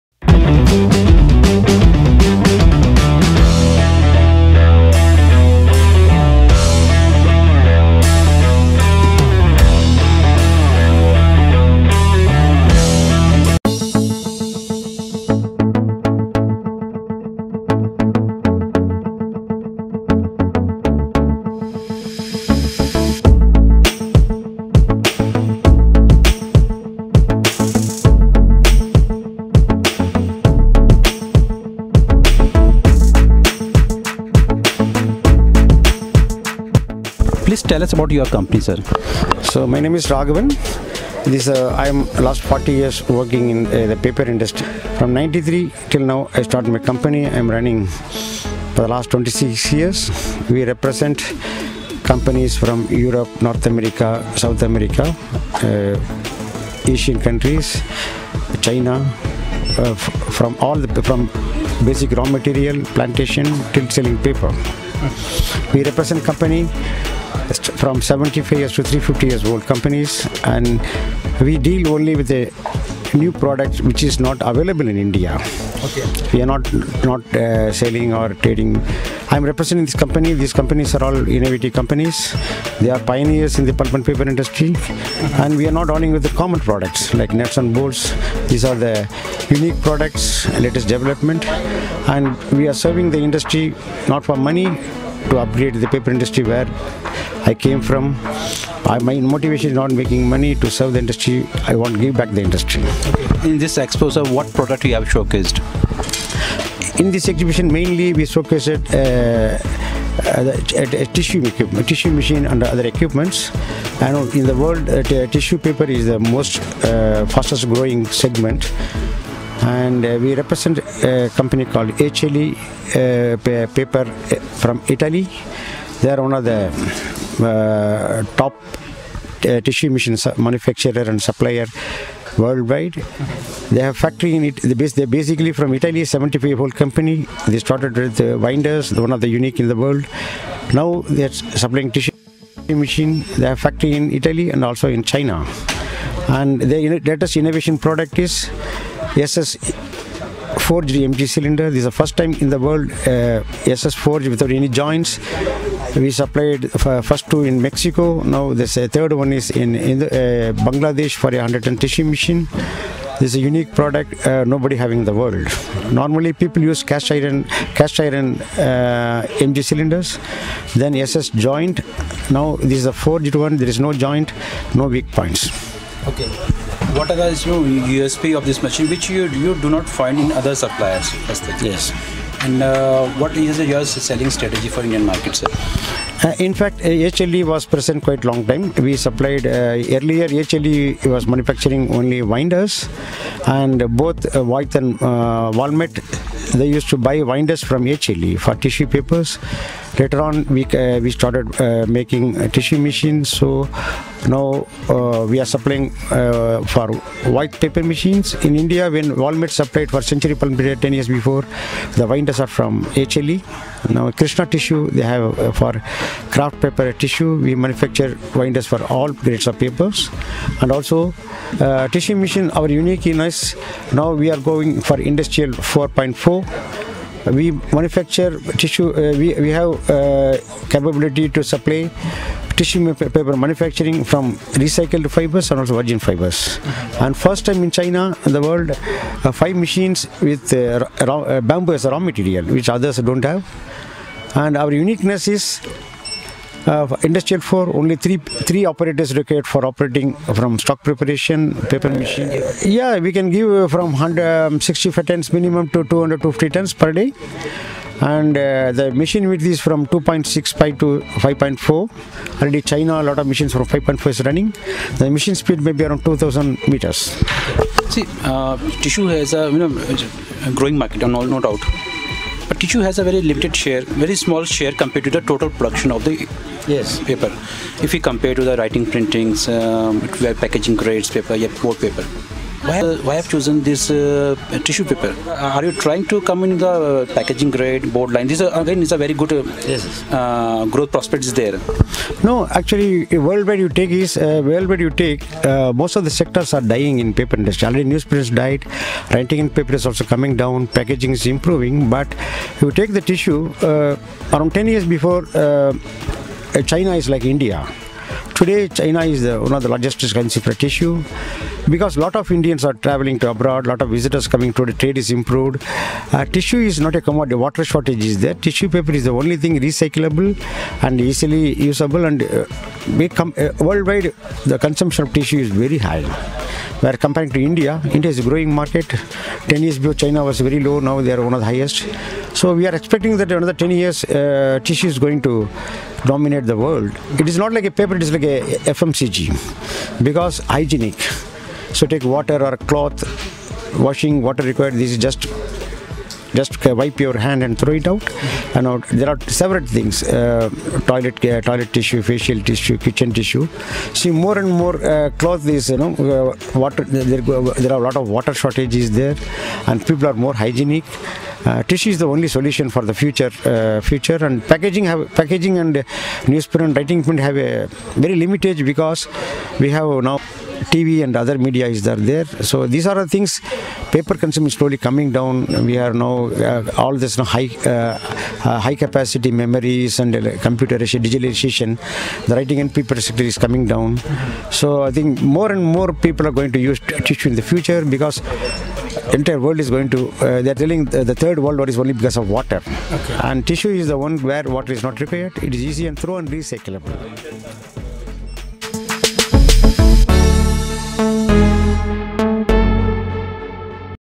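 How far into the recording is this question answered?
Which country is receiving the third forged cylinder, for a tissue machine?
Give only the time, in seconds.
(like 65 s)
160 s.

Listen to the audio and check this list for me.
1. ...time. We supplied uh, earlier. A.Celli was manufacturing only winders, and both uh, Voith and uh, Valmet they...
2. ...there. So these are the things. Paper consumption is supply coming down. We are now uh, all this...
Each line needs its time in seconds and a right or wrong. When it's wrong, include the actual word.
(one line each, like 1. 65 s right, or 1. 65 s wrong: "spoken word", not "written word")
1. 188 s right
2. 371 s wrong: "slowly", not "supply".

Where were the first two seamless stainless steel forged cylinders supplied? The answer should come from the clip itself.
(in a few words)
Mexico.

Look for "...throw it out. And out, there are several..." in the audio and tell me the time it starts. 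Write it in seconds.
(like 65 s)
347 s.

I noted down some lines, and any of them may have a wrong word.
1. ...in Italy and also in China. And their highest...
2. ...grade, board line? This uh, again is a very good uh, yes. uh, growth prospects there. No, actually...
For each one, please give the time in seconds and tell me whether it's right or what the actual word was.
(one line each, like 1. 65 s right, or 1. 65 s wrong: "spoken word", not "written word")
1. 143 s wrong: "latest", not "highest"
2. 287 s right.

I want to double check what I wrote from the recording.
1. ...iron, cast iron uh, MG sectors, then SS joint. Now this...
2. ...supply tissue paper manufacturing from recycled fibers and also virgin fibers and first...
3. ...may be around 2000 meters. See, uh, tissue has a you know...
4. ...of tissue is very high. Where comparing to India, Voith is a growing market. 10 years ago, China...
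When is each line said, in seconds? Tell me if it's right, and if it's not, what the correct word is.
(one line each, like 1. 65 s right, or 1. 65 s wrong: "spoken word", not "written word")
1. 167 s wrong: "cylinders", not "sectors"
2. 231 s right
3. 265 s right
4. 325 s wrong: "India", not "Voith".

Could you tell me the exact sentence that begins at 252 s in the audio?
Yeah, we can give from 165 um, tons minimum to 250 tons per day.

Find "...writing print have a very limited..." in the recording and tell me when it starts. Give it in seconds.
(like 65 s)
366 s.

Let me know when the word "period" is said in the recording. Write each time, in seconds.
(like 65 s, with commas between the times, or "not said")
210 s.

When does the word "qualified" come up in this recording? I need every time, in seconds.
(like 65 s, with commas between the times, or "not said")
not said.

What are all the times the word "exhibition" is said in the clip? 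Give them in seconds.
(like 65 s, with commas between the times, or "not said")
107 s.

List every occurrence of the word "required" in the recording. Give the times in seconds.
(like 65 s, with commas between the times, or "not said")
249 s, 344 s, 394 s.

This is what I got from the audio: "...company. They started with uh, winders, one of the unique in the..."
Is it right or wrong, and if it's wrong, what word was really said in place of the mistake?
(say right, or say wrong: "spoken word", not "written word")
right.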